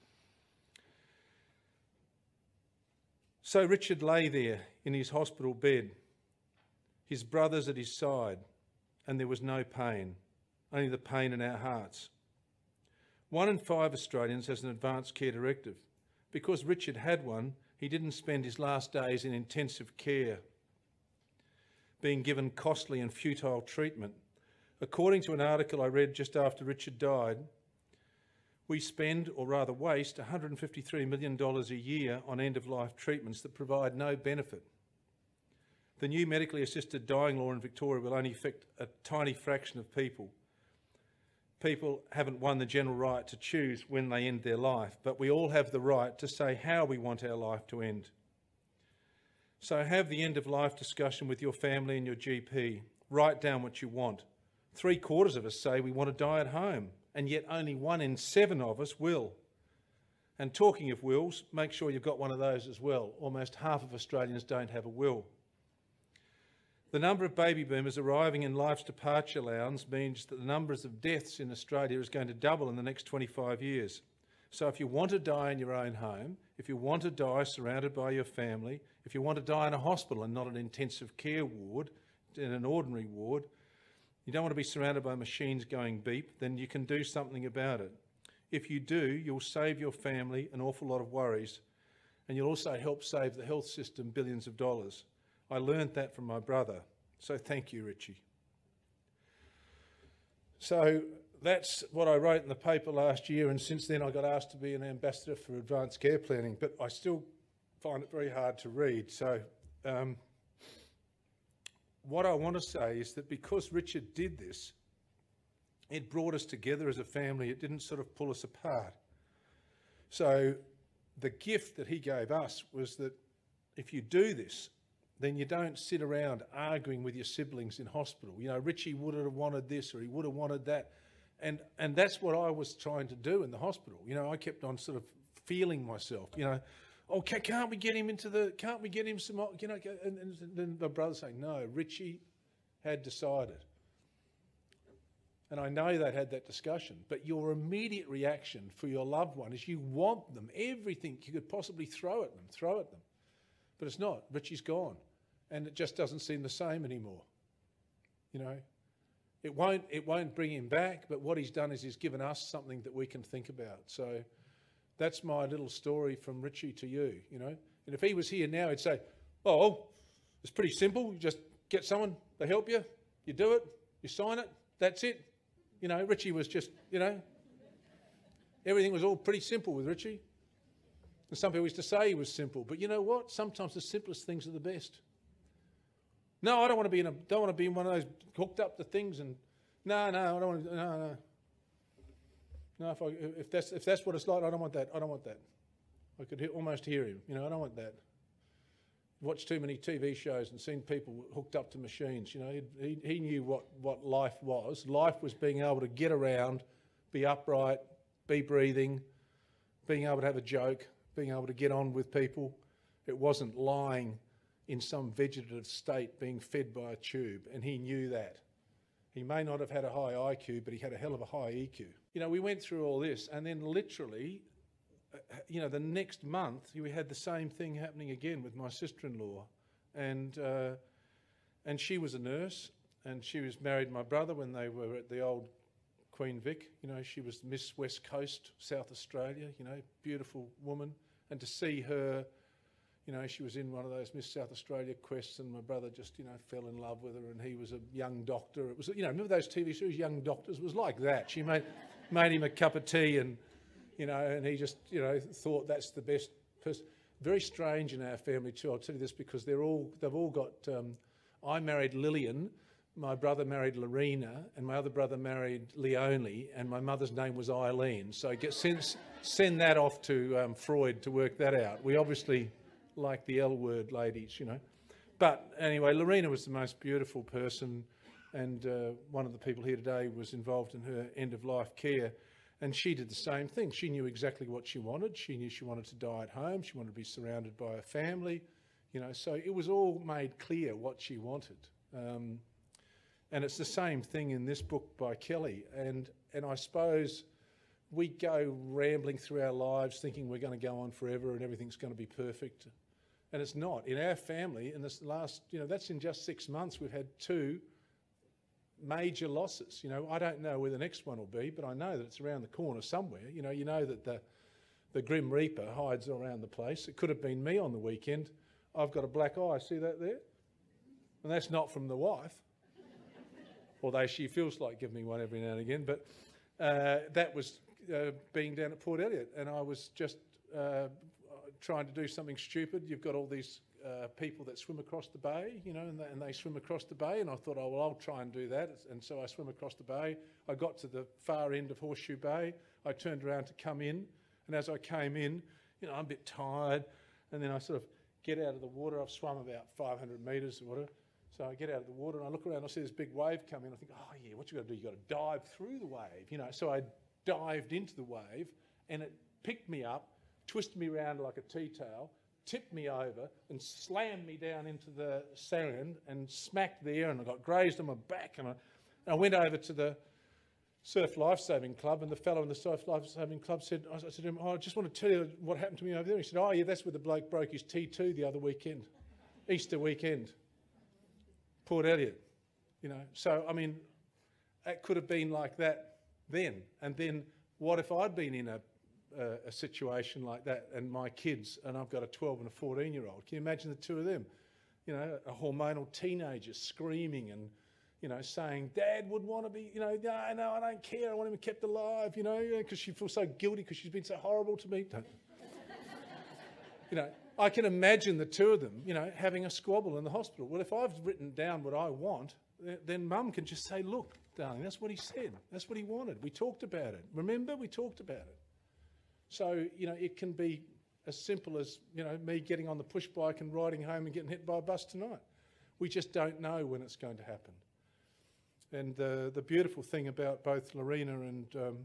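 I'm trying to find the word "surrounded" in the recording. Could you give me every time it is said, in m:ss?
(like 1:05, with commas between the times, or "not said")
1:17, 1:24, 4:47.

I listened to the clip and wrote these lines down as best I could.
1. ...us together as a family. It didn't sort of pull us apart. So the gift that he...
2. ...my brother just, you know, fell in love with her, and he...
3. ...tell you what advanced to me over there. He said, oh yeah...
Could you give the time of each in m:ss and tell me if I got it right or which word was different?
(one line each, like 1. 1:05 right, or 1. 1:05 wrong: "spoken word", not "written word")
1. 1:56 right
2. 4:05 right
3. 6:15 wrong: "happened", not "advanced".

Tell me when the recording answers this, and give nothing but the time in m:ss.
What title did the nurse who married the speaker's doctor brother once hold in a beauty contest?
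3:57.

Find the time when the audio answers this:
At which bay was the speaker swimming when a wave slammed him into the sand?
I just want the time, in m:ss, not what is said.
5:41.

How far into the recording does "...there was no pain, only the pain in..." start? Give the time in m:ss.
0:09.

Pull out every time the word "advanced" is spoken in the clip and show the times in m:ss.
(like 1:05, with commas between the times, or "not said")
0:14, 1:45.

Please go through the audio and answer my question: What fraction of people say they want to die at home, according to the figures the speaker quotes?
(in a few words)
Three quarters.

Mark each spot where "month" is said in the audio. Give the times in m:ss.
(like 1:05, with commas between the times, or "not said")
3:46, 5:06.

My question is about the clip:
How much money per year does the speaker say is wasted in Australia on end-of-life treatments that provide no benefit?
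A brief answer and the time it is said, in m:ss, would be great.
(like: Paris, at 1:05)
$153 million, at 0:30.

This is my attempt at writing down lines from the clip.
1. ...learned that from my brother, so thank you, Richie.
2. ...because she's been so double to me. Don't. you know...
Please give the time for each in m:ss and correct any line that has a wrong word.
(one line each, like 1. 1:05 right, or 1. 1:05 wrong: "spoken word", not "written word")
1. 1:35 right
2. 6:43 wrong: "horrible", not "double".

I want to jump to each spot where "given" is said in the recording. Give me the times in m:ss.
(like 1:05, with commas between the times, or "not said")
0:22, 2:41.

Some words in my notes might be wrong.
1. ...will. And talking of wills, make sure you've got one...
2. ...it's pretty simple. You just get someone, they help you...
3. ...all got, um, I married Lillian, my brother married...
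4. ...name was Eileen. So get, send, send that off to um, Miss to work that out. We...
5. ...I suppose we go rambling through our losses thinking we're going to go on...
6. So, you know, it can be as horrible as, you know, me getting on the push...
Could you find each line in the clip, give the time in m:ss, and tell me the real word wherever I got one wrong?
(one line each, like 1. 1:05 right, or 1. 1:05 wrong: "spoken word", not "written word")
1. 0:58 right
2. 2:50 right
3. 4:20 right
4. 4:27 wrong: "Freud", not "Miss"
5. 4:56 wrong: "lives", not "losses"
6. 6:59 wrong: "simple", not "horrible".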